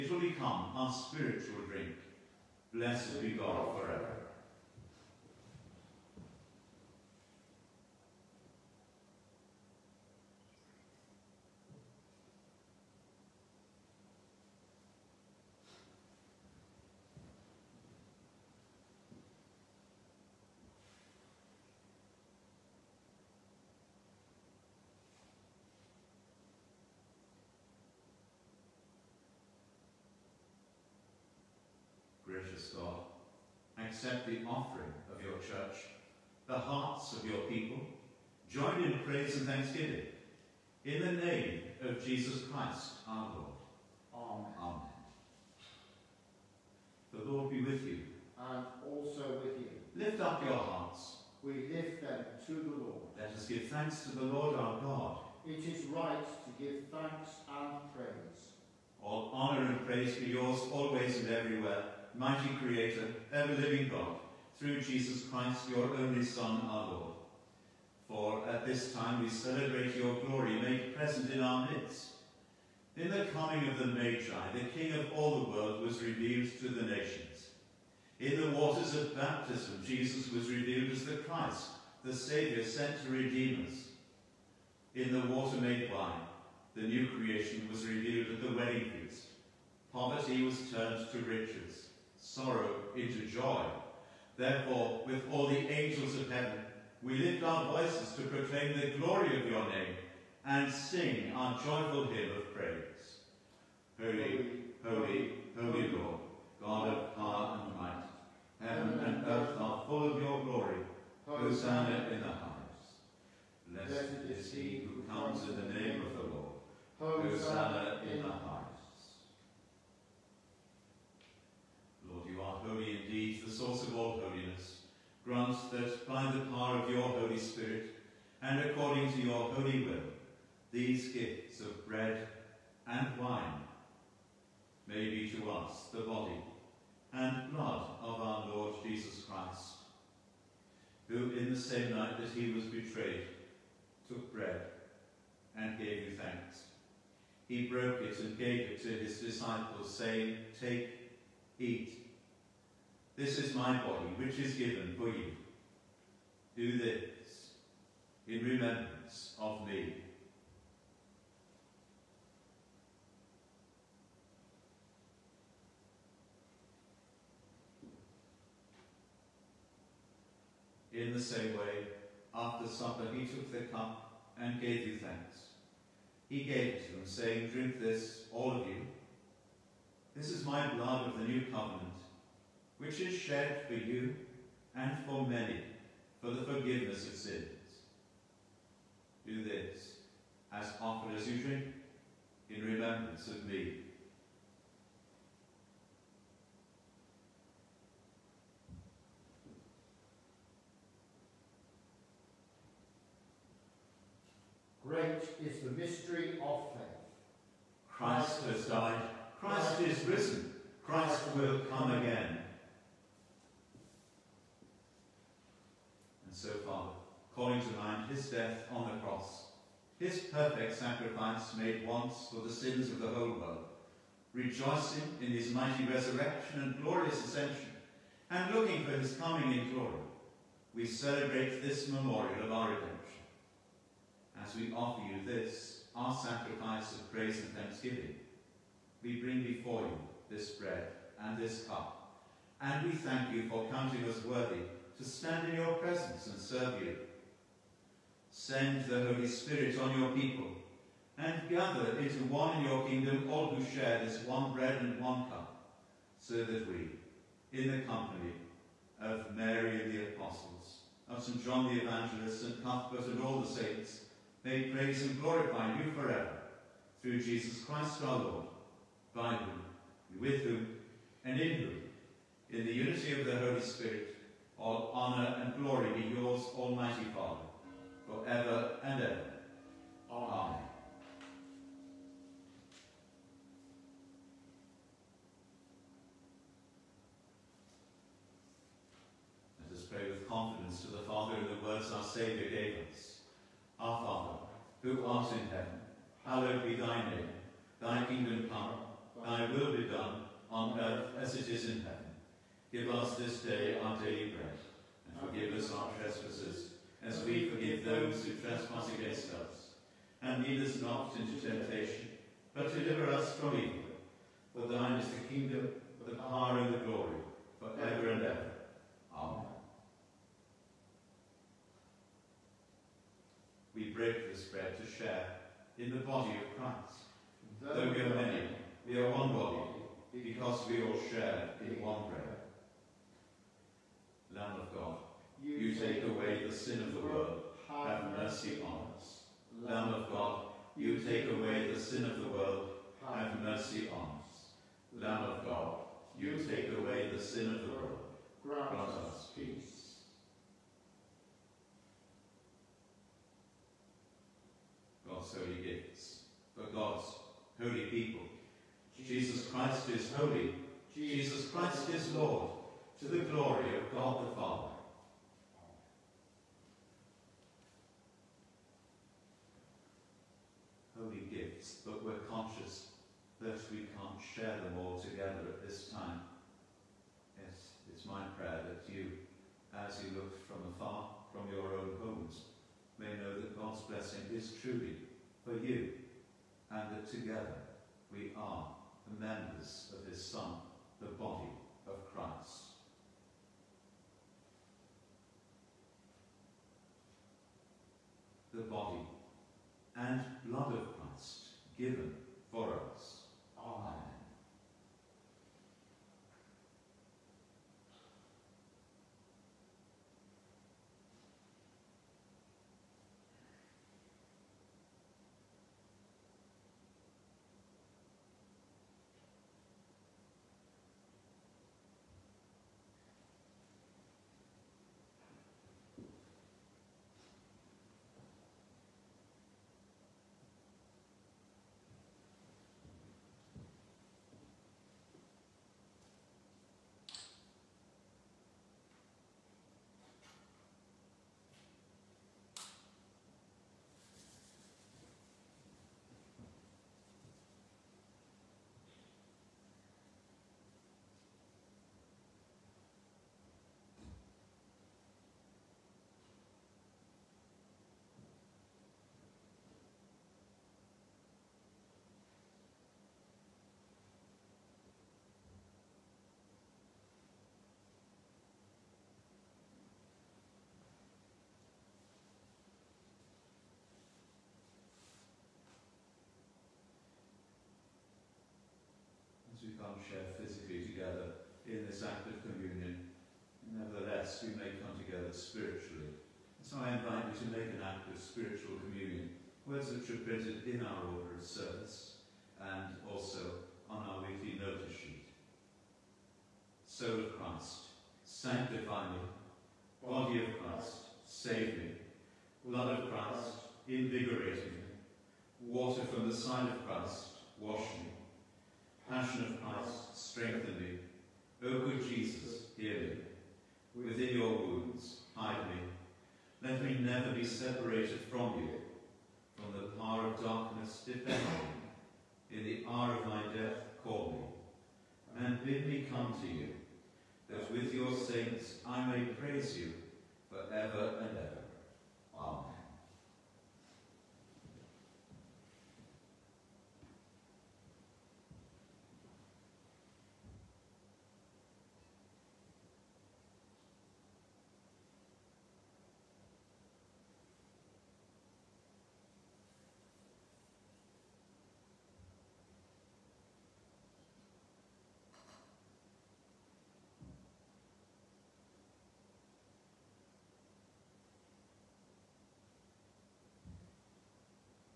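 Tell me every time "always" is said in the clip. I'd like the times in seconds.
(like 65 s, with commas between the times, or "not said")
60 s.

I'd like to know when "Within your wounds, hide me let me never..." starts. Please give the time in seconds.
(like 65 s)
514 s.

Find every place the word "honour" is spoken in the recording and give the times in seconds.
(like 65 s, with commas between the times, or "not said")
59 s, 274 s.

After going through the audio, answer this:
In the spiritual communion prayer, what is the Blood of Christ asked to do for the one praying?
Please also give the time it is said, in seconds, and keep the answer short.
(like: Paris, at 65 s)
invigorate me, at 503 s.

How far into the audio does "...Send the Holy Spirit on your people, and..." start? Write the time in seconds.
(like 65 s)
248 s.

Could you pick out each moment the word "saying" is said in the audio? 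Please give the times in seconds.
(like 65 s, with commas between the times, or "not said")
149 s, 177 s.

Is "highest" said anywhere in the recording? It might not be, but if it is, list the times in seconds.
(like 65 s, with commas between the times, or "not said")
112 s, 118 s.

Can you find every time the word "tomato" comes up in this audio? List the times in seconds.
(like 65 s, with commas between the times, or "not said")
not said.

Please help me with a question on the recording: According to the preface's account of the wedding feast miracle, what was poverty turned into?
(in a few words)
riches.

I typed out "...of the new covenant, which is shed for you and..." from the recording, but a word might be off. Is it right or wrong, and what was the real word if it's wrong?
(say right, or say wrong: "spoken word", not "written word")
right.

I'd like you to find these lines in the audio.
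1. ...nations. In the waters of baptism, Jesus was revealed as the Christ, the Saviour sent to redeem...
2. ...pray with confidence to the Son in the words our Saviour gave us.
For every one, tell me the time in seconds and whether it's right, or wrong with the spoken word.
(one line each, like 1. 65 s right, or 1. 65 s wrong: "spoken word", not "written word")
1. 76 s right
2. 289 s wrong: "Father", not "Son".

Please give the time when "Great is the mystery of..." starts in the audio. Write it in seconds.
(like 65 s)
204 s.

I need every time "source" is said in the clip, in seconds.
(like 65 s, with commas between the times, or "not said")
123 s.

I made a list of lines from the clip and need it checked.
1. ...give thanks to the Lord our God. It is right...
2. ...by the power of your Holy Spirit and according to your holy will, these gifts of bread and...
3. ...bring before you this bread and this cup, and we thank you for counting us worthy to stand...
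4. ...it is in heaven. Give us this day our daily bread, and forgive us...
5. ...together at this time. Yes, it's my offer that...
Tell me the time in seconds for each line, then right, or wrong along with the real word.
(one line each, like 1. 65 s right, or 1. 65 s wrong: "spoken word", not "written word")
1. 53 s right
2. 126 s right
3. 239 s right
4. 301 s right
5. 375 s wrong: "prayer", not "offer".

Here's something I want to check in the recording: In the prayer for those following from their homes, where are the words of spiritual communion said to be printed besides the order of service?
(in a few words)
weekly notice sheet.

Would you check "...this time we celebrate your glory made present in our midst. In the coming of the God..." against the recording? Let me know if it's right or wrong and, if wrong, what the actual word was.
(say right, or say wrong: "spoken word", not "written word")
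wrong: "Magi", not "God".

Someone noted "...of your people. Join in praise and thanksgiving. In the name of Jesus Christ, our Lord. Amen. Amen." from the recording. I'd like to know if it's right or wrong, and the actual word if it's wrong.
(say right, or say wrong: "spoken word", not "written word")
right.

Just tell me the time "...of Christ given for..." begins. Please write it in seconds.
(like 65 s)
400 s.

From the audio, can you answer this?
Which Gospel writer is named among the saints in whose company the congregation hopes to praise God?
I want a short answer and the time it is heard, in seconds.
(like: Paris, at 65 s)
St. John the Evangelist, at 261 s.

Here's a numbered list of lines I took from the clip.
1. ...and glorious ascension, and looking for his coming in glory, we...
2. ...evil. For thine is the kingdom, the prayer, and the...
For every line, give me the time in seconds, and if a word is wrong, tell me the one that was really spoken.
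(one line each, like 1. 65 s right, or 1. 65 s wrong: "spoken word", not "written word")
1. 226 s right
2. 313 s wrong: "power", not "prayer".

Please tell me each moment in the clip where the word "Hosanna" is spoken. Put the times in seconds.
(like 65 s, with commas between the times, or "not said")
111 s, 117 s.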